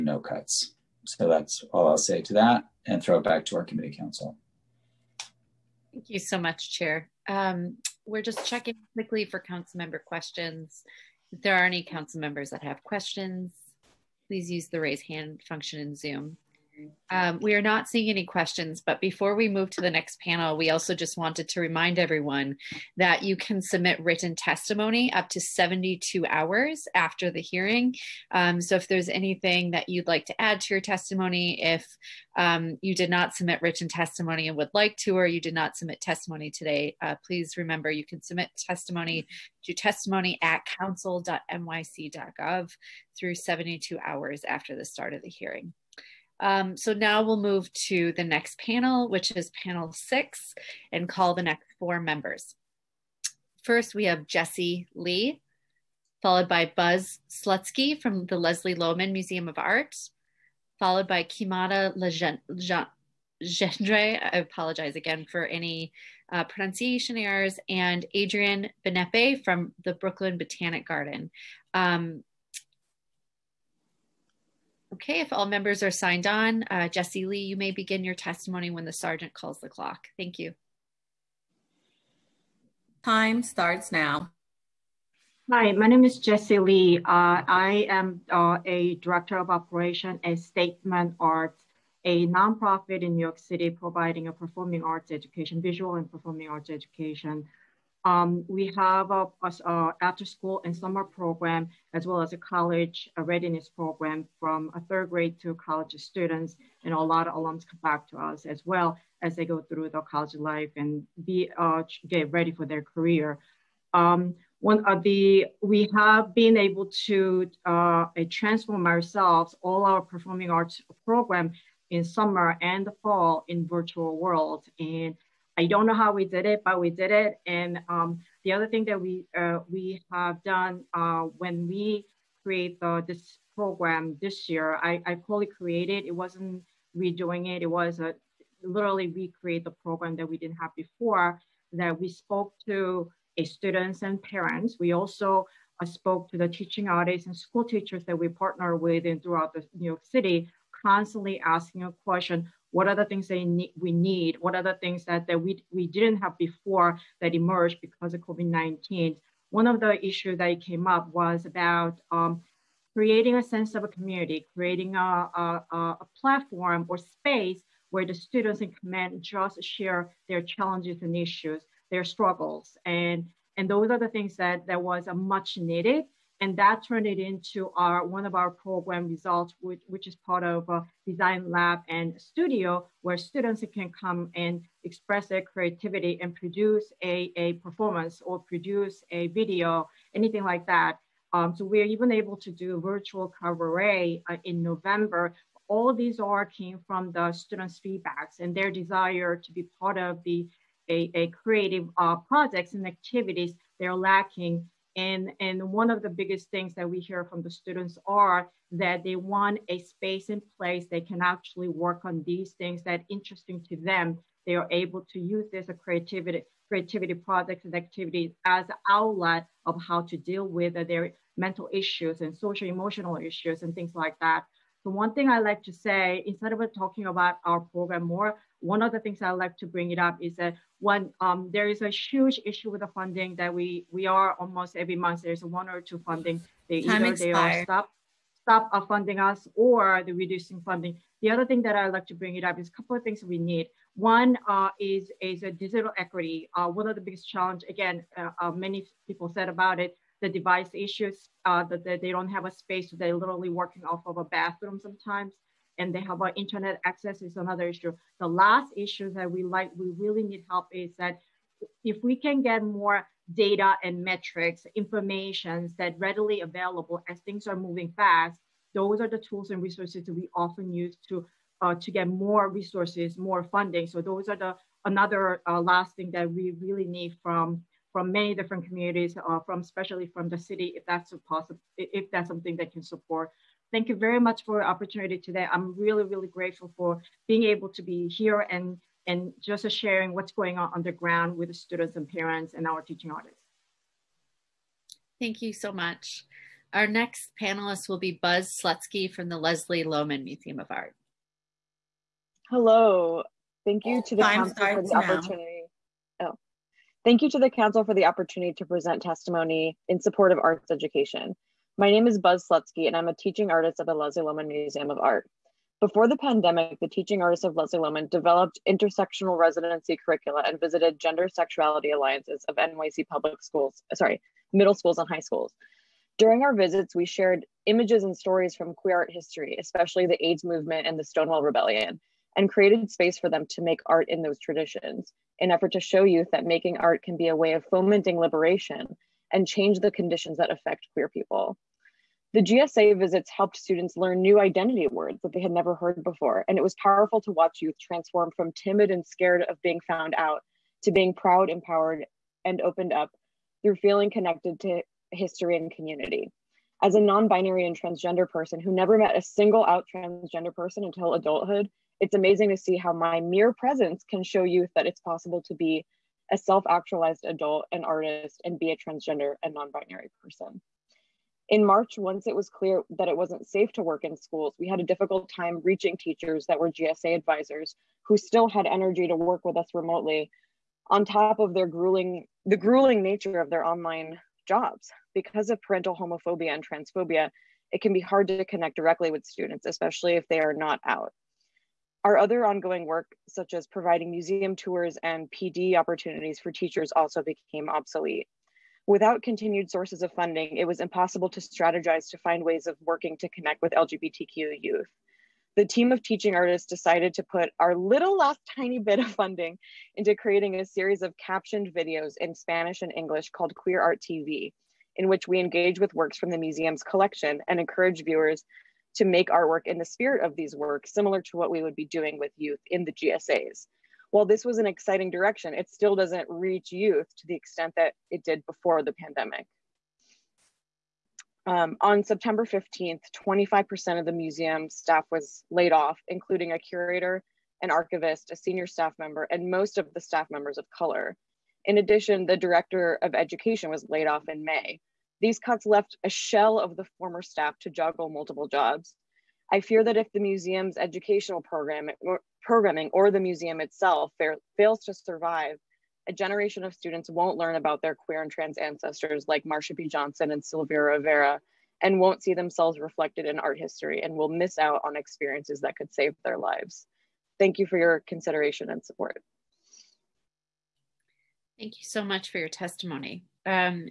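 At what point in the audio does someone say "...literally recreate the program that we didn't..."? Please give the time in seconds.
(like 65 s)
138 s.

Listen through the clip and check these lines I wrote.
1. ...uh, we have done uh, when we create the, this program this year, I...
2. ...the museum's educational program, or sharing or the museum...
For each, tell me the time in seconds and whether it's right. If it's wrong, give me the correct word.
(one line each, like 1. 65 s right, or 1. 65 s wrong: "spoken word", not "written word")
1. 129 s right
2. 450 s wrong: "programming", not "sharing".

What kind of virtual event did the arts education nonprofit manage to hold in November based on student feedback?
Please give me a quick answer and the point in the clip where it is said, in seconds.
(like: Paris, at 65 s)
virtual cabaret, at 192 s.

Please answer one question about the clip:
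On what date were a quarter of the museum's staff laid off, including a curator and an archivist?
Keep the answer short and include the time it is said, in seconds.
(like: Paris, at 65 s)
September 15, at 432 s.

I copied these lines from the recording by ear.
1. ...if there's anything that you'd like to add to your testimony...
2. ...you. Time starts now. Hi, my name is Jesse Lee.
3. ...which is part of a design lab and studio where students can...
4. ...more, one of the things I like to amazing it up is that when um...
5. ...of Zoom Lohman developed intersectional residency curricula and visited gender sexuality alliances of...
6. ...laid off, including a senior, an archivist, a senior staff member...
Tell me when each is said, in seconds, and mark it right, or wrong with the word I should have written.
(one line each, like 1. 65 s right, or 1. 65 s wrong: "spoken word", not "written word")
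1. 28 s right
2. 80 s right
3. 179 s right
4. 228 s wrong: "bring", not "amazing"
5. 317 s wrong: "Leslie", not "Zoom"
6. 435 s wrong: "curator", not "senior".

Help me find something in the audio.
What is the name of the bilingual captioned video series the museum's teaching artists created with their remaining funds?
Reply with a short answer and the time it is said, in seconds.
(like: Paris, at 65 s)
Queer Art TV, at 413 s.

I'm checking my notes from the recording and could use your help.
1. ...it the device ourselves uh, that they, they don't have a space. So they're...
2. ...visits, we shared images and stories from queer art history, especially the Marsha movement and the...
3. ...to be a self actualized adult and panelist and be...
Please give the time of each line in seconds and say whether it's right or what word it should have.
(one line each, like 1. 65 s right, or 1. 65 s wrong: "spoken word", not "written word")
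1. 249 s wrong: "issues", not "ourselves"
2. 326 s wrong: "AIDS", not "Marsha"
3. 365 s wrong: "artist", not "panelist".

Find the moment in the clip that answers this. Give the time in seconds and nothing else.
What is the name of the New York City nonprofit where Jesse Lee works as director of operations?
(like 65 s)
90 s.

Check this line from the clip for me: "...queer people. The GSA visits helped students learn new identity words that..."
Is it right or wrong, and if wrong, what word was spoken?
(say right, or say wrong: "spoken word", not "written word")
right.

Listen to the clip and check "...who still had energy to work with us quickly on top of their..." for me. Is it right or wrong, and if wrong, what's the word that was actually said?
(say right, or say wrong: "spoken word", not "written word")
wrong: "remotely", not "quickly".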